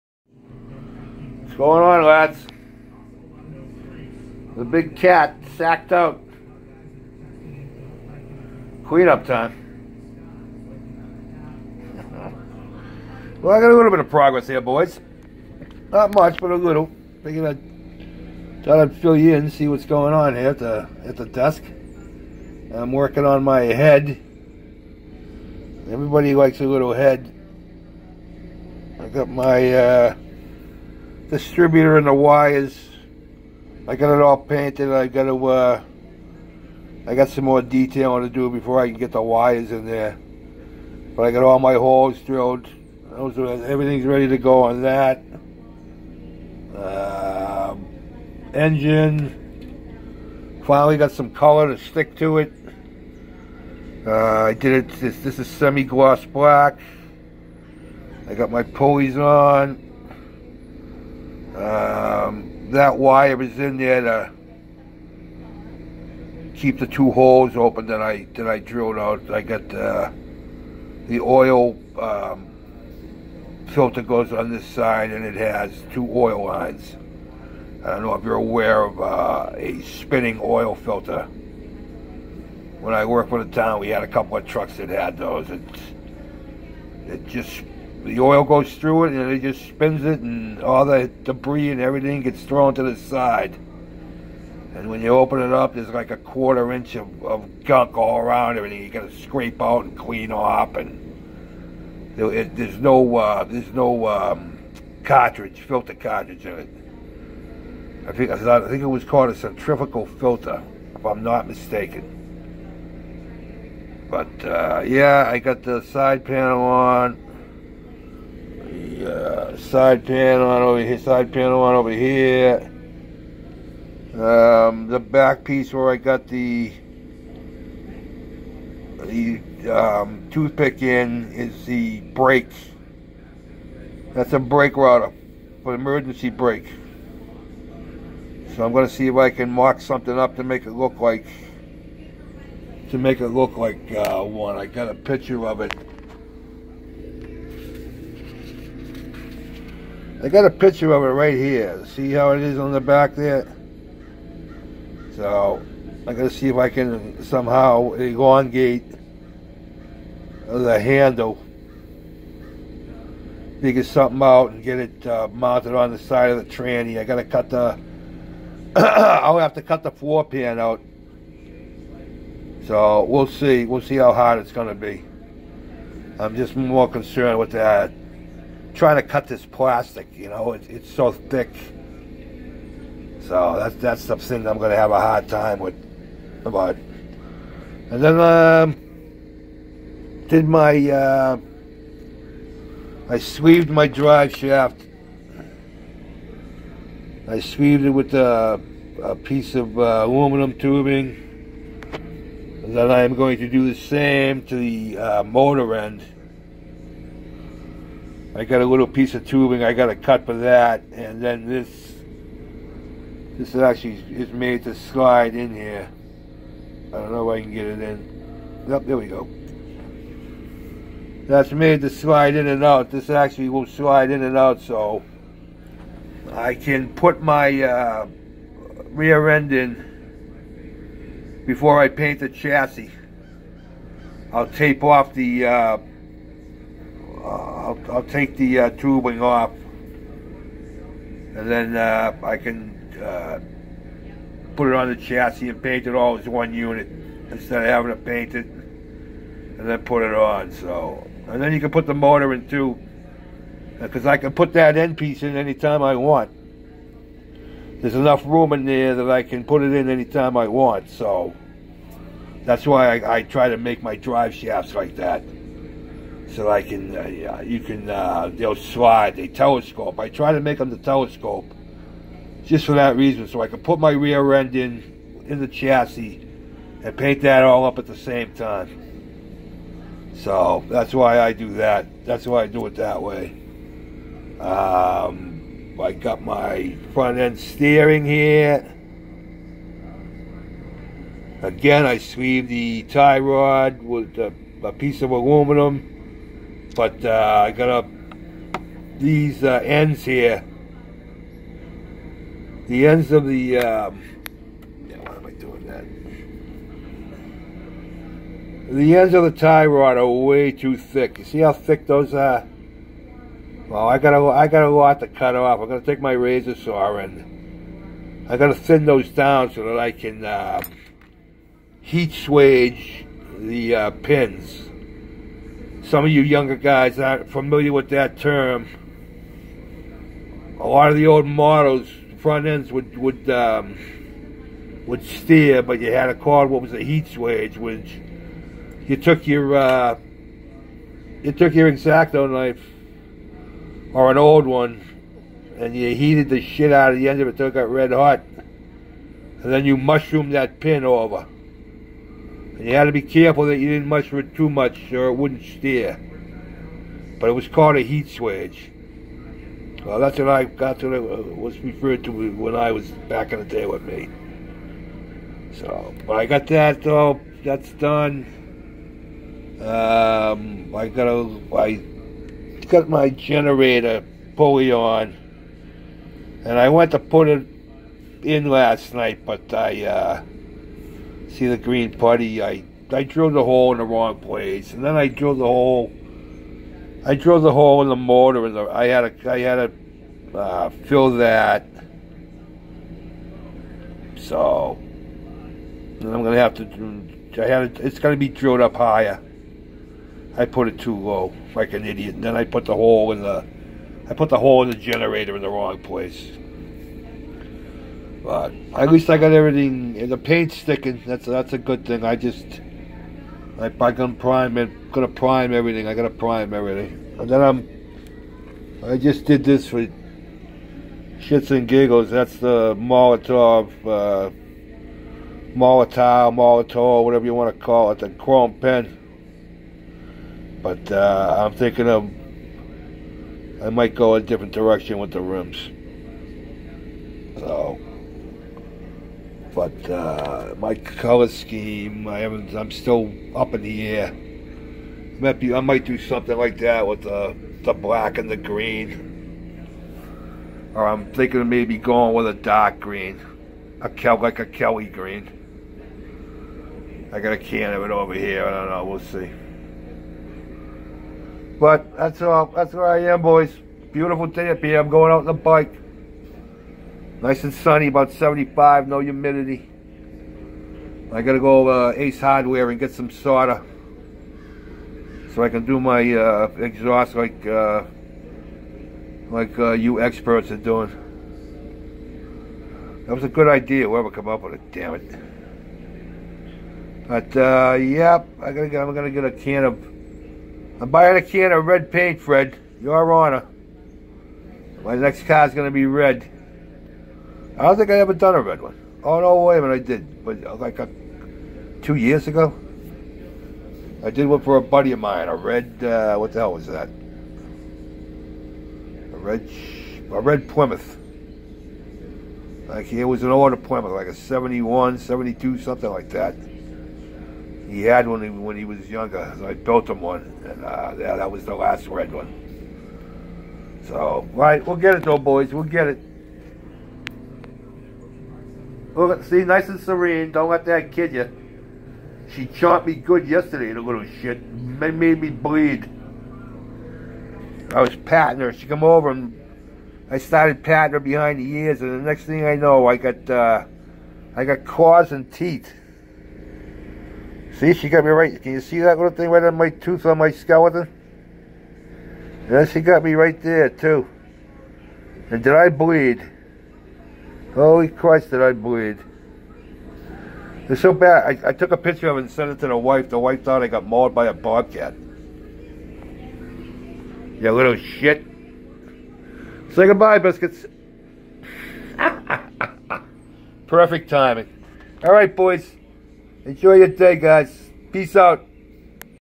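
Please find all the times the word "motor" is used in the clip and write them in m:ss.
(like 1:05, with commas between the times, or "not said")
3:25, 4:11.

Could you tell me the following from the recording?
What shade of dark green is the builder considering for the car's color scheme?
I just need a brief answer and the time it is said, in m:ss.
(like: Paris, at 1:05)
Kelly green, at 7:34.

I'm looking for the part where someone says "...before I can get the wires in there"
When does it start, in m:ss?
0:38.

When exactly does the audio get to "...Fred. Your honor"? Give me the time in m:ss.
8:12.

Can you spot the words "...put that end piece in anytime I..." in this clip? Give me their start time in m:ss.
4:14.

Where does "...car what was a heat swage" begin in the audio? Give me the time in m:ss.
5:36.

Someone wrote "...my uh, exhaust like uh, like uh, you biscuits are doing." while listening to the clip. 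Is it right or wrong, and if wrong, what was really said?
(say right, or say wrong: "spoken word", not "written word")
wrong: "experts", not "biscuits".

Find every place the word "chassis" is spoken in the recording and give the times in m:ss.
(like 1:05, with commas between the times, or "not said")
3:52, 4:04, 4:35.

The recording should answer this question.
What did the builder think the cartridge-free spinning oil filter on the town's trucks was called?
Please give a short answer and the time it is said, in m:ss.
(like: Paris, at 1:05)
Centrifugal filter, at 1:49.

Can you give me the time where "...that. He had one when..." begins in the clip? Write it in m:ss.
8:36.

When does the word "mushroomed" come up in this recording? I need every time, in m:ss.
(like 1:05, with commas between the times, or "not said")
5:49.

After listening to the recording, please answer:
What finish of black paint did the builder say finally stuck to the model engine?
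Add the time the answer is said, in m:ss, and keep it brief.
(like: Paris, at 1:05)
Semi-gloss black, at 0:55.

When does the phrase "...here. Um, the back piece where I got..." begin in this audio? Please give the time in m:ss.
2:01.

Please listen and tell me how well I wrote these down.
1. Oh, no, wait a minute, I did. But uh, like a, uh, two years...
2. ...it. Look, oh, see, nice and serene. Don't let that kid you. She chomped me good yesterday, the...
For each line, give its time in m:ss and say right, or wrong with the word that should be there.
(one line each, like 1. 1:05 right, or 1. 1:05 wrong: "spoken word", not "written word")
1. 8:19 right
2. 8:45 right.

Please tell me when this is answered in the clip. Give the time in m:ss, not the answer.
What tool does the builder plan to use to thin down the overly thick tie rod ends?
5:16.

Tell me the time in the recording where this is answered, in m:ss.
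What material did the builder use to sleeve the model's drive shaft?
3:20.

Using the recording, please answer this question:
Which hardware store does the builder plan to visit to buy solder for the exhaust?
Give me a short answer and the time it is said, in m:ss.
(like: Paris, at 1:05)
Ace Hardware, at 7:51.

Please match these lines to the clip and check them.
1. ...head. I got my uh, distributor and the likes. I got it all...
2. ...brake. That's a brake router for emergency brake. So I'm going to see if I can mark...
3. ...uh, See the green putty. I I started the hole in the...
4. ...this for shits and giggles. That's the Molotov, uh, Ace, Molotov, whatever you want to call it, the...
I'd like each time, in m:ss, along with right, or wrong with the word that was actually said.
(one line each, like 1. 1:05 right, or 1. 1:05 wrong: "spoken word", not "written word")
1. 0:26 wrong: "wires", not "likes"
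2. 2:12 right
3. 6:19 wrong: "drilled", not "started"
4. 6:59 wrong: "Molotov", not "Ace".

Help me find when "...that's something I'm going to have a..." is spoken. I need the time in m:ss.
3:03.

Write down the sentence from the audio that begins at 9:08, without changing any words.
Can you see that little thing right on my tooth on my skeleton?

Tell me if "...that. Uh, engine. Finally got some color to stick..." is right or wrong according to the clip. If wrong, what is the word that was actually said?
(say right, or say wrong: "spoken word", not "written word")
right.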